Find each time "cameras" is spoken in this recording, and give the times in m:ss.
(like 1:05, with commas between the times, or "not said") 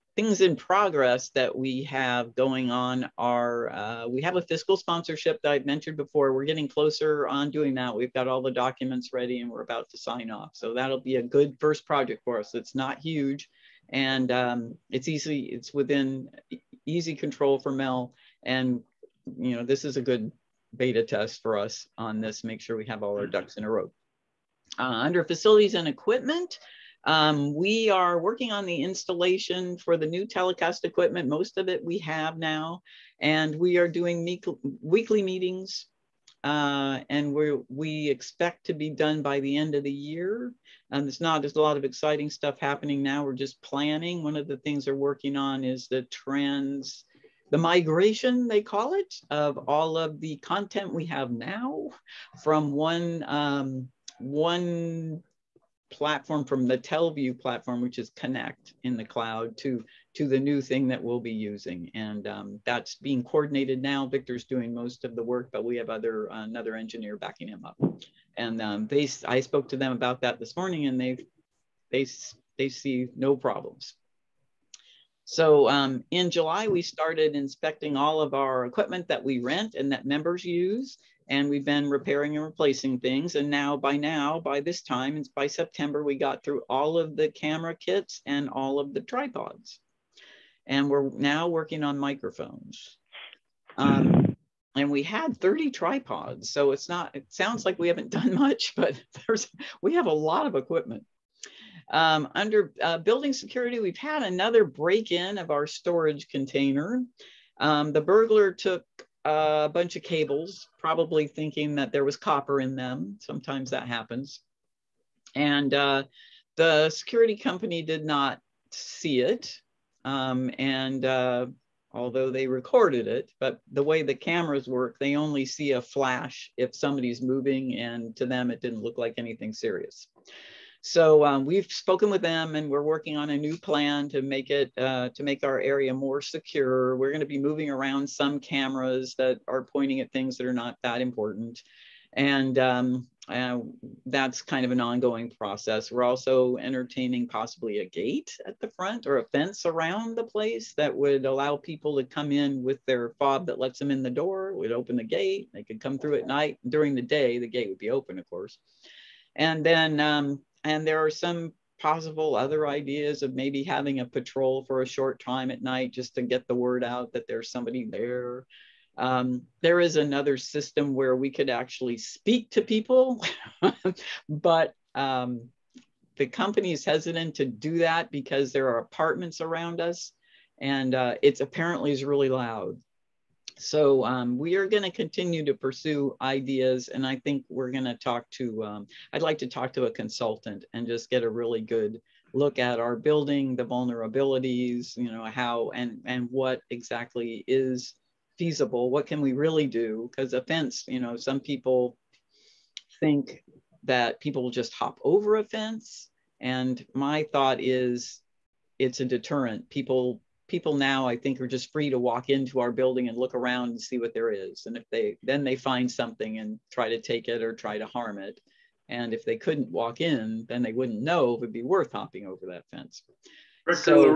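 1:27, 2:04, 2:18.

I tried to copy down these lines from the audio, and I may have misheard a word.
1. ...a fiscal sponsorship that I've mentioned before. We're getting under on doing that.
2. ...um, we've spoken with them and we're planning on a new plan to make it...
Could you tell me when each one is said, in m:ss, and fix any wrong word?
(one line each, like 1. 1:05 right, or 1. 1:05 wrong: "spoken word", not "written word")
1. 0:04 wrong: "closer", not "under"
2. 2:11 wrong: "working", not "planning".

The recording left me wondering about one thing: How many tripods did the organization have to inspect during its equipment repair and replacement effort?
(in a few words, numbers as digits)
30.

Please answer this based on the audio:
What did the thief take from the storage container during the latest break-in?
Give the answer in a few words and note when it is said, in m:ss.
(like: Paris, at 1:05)
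cables, at 1:50.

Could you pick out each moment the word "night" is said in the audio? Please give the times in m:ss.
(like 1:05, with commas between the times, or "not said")
2:36, 2:45.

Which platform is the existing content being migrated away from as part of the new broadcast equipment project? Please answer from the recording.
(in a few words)
TelVue.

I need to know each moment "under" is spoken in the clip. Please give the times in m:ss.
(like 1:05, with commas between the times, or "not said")
0:24, 1:42.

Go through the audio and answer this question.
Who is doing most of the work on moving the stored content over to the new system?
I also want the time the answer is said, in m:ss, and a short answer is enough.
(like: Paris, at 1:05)
Victor, at 1:04.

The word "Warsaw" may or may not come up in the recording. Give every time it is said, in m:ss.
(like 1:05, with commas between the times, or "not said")
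not said.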